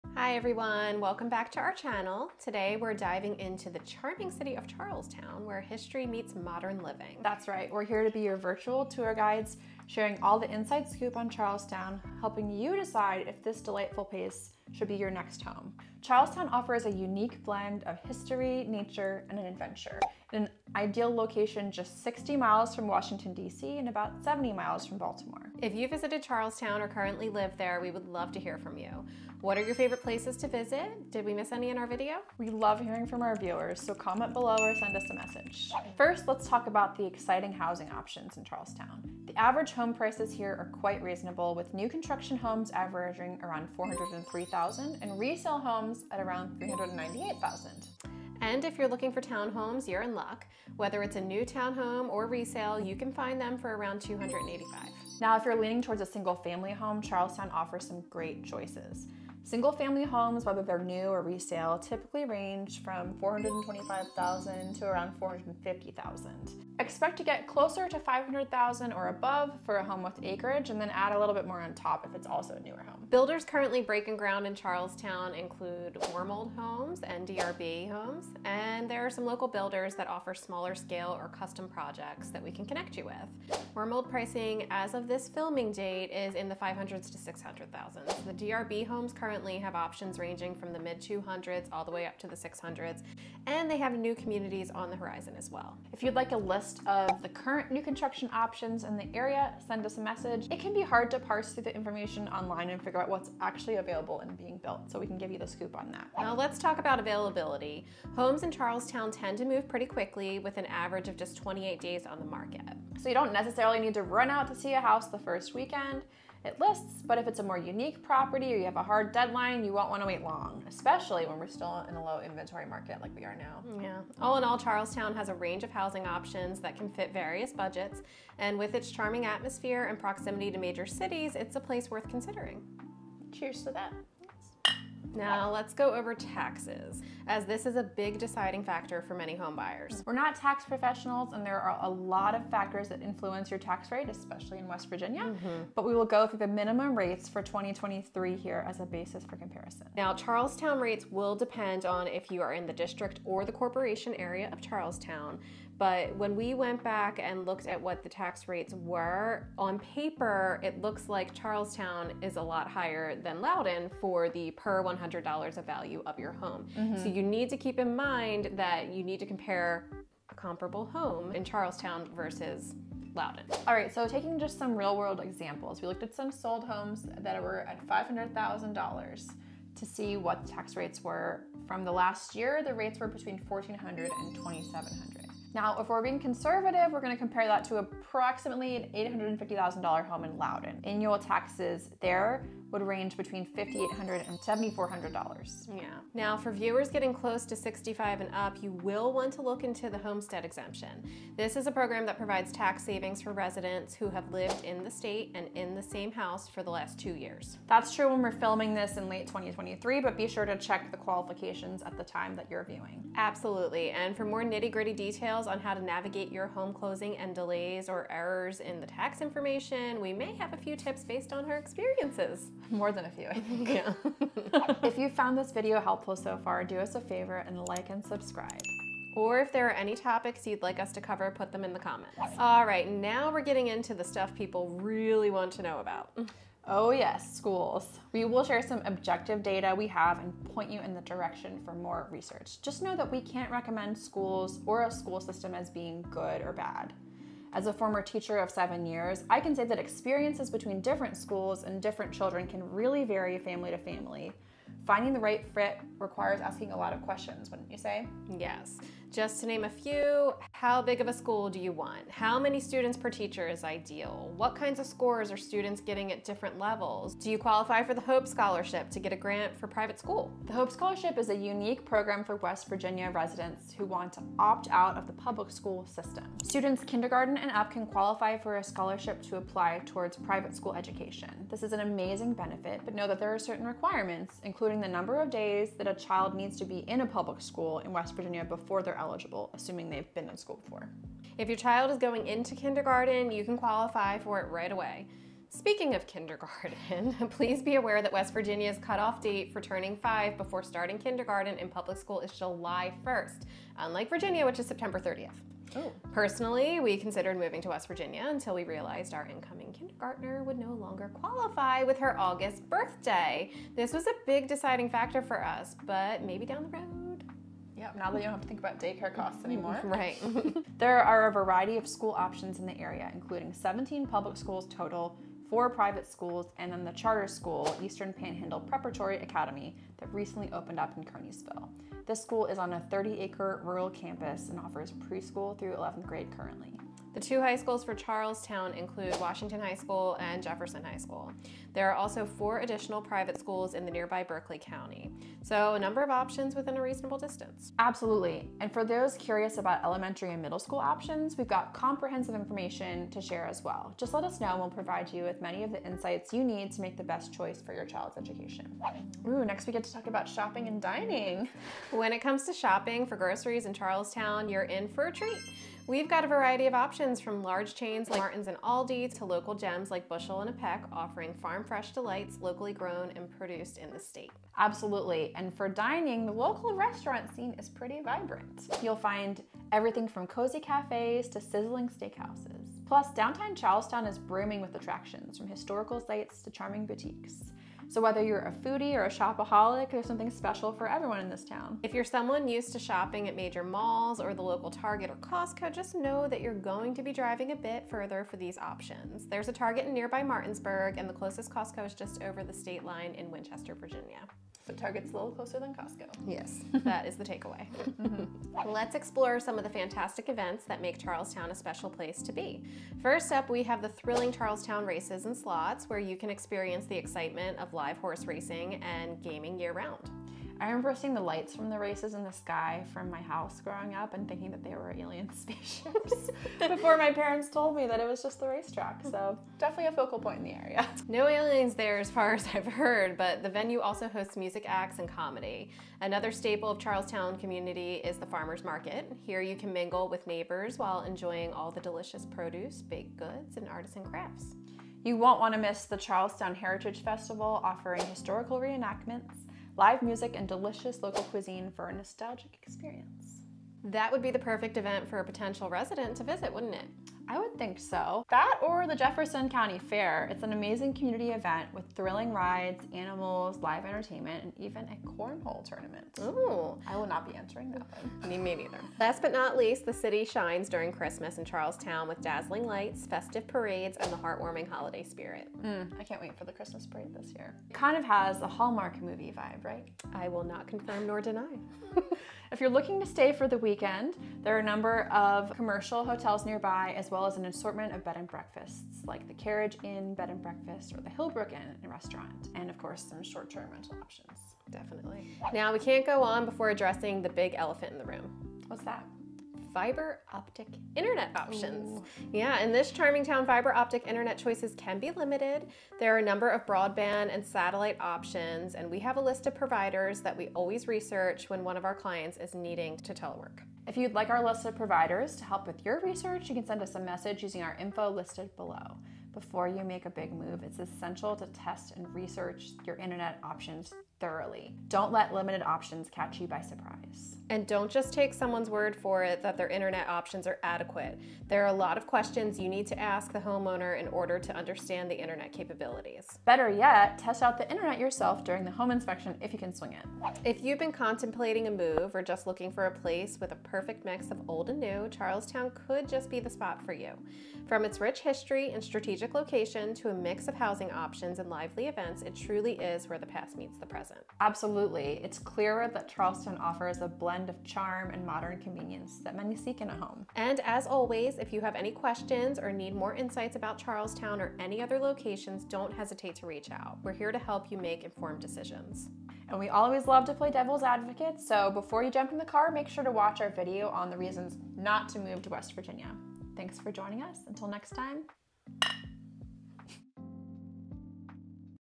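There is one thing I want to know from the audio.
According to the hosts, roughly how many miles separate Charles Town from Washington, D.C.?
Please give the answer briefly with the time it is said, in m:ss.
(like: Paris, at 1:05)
60 miles, at 0:22.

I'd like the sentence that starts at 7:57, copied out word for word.
It kind of has a Hallmark movie vibe, right?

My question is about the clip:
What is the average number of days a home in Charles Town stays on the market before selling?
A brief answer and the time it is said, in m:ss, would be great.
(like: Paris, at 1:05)
28 days, at 1:51.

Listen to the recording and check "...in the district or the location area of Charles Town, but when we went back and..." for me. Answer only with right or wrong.
wrong.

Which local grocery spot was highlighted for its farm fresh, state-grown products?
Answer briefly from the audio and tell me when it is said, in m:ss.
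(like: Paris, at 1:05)
Bushel and a Peck, at 6:10.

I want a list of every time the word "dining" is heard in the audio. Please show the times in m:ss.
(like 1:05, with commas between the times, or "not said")
6:00, 6:15.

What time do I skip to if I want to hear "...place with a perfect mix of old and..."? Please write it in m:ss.
9:02.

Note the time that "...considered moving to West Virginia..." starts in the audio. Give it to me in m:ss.
5:06.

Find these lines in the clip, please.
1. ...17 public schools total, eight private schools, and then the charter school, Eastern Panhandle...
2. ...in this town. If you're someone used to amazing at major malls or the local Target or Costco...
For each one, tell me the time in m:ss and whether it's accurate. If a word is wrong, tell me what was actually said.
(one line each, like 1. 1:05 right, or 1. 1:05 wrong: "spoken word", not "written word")
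1. 5:23 wrong: "four", not "eight"
2. 6:31 wrong: "shopping", not "amazing".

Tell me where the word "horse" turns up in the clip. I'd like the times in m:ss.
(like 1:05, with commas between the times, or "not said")
6:57.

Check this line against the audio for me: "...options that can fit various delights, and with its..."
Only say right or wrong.
wrong.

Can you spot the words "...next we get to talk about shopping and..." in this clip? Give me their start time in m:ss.
5:59.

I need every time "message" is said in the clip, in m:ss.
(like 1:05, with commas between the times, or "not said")
0:35, 1:40, 8:36.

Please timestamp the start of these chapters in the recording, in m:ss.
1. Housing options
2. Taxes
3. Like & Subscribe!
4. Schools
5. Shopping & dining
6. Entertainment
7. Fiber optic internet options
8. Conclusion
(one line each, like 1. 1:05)
1. 0:36
2. 2:16
3. 3:45
4. 3:56
5. 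5:59
6. 6:49
7. 8:15
8. 9:00.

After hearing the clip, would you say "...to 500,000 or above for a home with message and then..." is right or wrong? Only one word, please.
wrong.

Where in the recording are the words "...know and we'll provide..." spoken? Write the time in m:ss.
5:54.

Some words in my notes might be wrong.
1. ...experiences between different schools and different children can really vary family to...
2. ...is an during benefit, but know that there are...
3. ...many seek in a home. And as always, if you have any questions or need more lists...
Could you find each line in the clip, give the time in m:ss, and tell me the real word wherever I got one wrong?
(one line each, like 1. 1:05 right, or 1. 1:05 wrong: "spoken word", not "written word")
1. 4:09 right
2. 4:41 wrong: "amazing", not "during"
3. 9:19 wrong: "insights", not "lists".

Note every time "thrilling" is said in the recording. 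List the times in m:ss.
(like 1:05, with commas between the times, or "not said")
6:53, 7:41.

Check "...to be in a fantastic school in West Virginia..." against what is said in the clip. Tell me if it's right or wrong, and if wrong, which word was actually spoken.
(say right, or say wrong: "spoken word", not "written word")
wrong: "public", not "fantastic".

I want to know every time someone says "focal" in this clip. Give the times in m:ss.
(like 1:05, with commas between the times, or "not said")
7:09.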